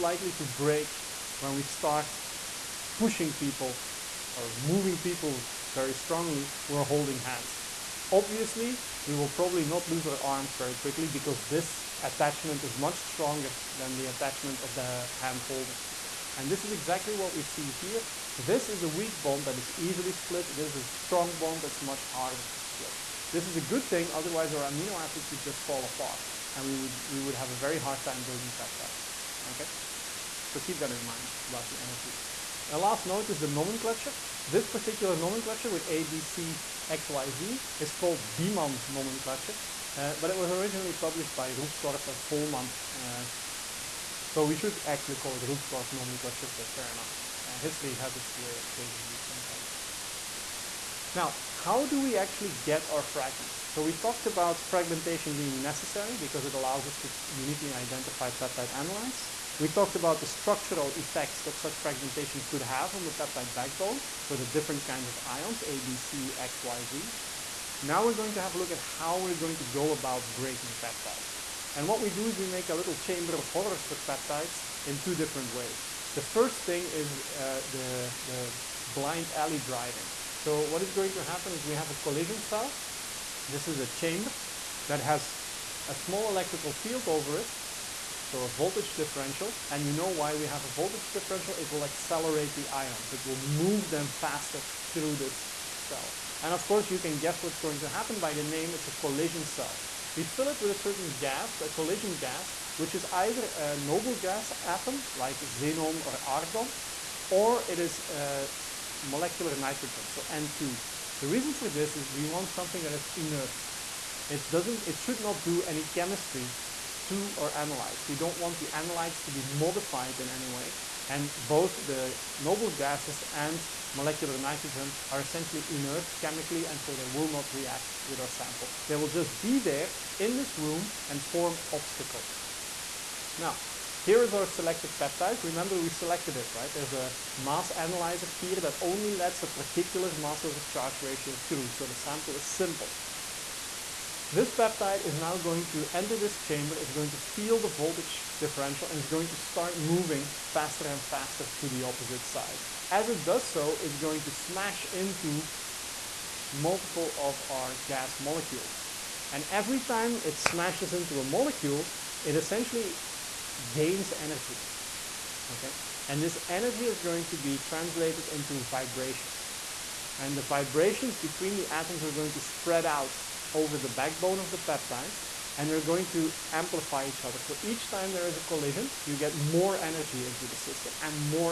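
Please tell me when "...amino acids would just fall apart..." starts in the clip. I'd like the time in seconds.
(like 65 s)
24 s.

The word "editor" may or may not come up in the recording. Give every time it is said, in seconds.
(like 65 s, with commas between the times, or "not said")
not said.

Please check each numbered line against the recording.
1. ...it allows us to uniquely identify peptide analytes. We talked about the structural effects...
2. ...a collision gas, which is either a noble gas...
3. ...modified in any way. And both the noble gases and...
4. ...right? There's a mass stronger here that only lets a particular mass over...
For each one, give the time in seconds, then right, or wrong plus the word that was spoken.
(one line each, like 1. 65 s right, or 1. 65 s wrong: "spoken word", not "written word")
1. 56 s right
2. 101 s right
3. 119 s right
4. 136 s wrong: "analyzer", not "stronger".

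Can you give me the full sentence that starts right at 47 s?
Uh, history has its way of changing these things, I guess.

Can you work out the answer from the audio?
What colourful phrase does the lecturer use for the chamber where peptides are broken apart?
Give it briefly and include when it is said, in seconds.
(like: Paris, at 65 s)
chamber of horrors, at 72 s.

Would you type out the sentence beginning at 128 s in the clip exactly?
They will just be there in this room and form obstacles.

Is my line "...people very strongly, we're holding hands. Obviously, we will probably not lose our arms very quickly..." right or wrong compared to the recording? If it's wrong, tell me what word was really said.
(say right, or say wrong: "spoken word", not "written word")
right.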